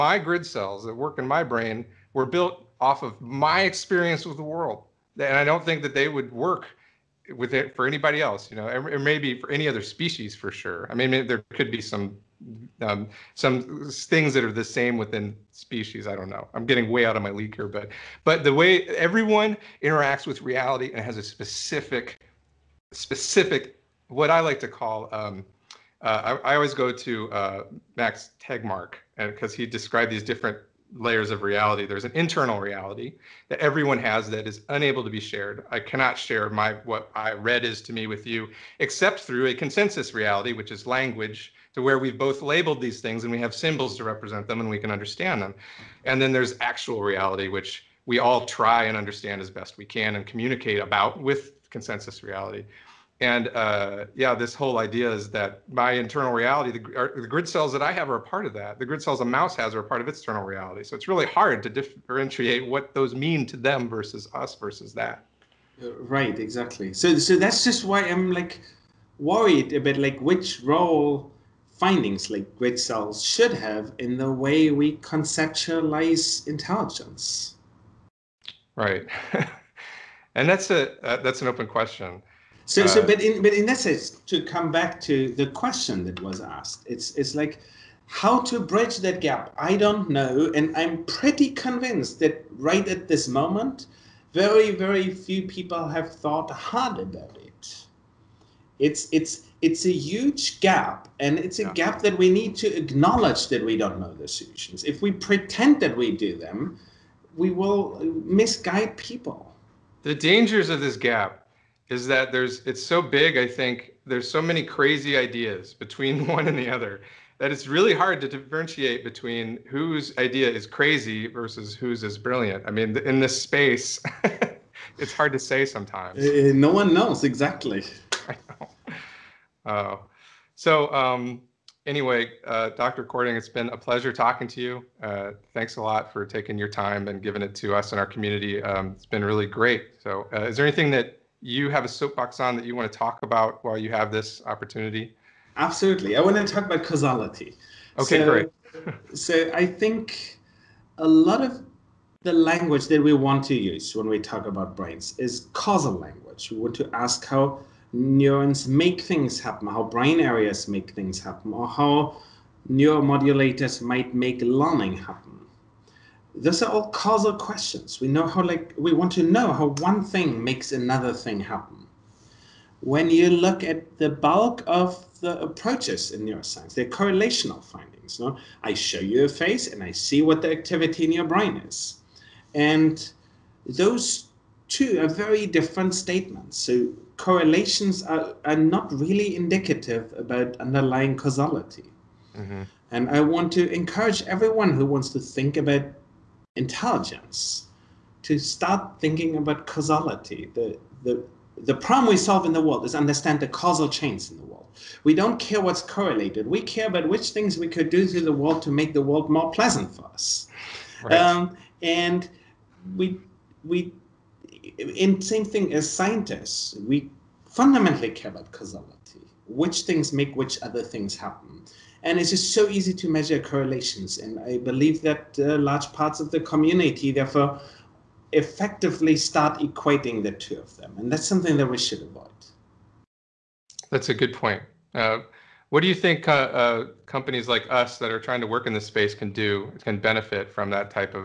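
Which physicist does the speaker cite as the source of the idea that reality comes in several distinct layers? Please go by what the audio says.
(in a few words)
Max Tegmark.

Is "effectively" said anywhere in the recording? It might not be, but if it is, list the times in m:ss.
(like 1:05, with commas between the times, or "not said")
3:48.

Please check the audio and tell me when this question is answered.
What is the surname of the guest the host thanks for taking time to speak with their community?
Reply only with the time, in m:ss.
2:13.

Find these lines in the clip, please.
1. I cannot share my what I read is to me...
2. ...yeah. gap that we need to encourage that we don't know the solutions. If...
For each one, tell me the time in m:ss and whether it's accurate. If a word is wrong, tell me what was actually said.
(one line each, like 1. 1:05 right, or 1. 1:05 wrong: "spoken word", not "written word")
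1. 0:35 right
2. 1:41 wrong: "acknowledge", not "encourage".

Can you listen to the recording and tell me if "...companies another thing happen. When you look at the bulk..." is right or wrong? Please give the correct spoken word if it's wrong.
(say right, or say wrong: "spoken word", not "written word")
wrong: "makes", not "companies".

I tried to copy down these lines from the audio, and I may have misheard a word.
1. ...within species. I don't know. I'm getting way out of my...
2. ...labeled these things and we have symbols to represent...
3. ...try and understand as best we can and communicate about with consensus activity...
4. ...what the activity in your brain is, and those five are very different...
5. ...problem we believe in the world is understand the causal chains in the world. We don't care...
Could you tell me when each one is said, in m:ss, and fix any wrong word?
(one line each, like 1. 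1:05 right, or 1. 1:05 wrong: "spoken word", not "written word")
1. 0:14 right
2. 0:42 right
3. 0:48 wrong: "reality", not "activity"
4. 3:00 wrong: "two", not "five"
5. 3:21 wrong: "solve", not "believe".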